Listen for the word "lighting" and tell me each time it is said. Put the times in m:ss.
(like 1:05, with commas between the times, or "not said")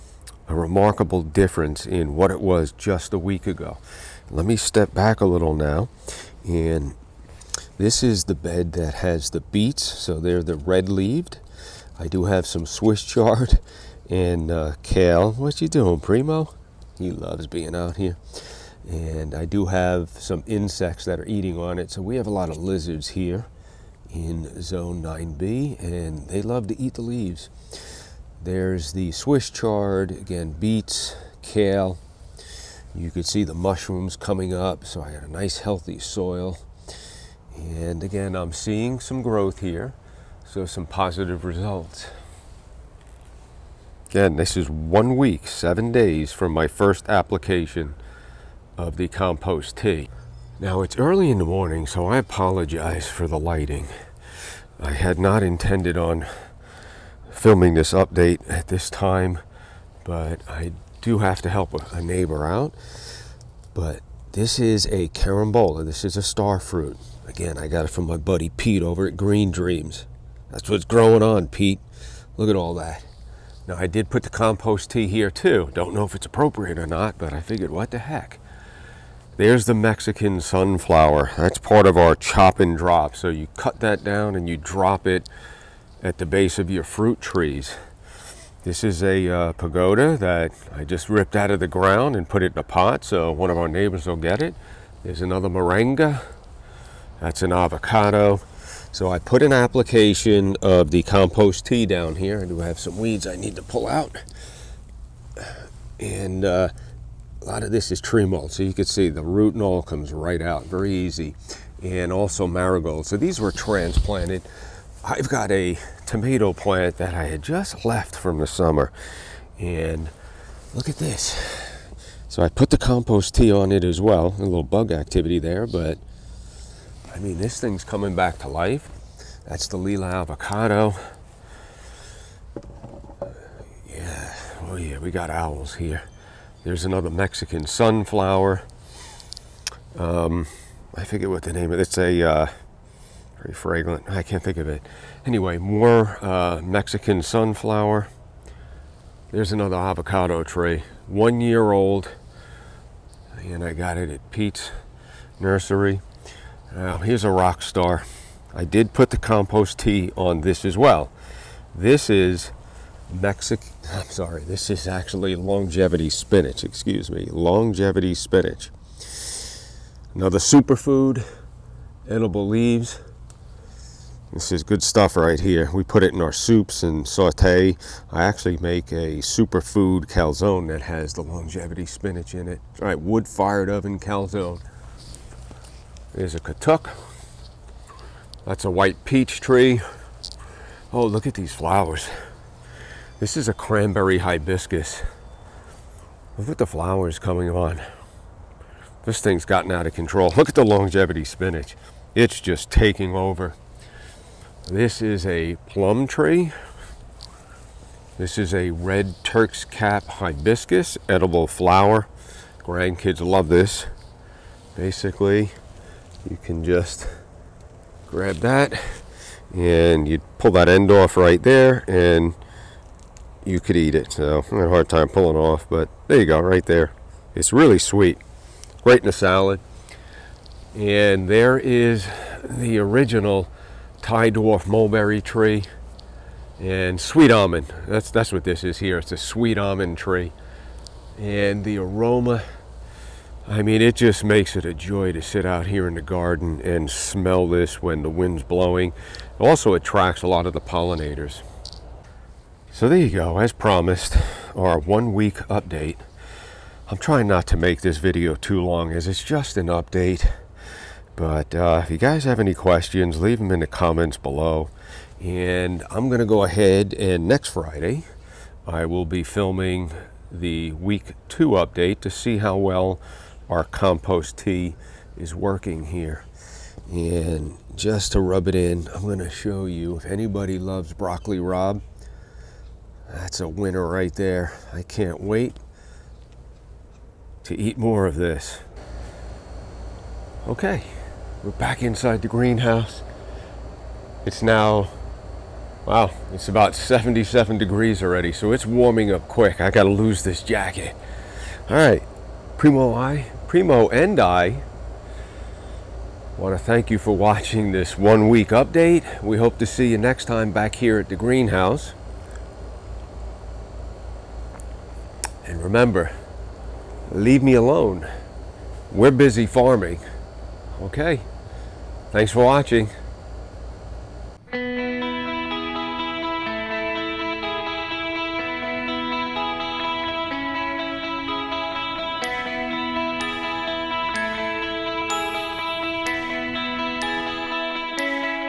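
0:53.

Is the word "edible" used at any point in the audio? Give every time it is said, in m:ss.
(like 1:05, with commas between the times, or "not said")
2:52, 3:31.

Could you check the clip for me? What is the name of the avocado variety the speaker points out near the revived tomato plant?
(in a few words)
Lila.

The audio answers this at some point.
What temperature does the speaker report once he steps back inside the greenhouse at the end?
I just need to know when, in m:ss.
4:56.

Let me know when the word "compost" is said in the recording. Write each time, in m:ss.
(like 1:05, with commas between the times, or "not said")
0:49, 1:14, 1:41, 2:02, 2:39, 4:33.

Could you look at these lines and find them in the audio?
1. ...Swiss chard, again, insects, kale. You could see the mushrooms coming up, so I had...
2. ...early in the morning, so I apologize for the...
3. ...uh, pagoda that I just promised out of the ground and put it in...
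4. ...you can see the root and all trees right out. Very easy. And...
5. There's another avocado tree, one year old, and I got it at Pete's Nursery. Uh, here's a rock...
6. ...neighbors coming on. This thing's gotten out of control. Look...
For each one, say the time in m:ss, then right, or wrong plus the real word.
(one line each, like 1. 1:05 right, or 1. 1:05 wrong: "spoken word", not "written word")
1. 0:29 wrong: "beets", not "insects"
2. 0:50 right
3. 1:29 wrong: "ripped", not "promised"
4. 1:48 wrong: "comes", not "trees"
5. 2:29 right
6. 3:16 wrong: "flowers", not "neighbors".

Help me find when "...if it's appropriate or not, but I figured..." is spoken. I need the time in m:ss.
1:16.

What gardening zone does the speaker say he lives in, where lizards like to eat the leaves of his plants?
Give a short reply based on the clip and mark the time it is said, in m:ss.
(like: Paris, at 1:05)
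9B, at 0:24.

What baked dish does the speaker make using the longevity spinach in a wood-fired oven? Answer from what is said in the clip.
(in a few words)
superfood calzone.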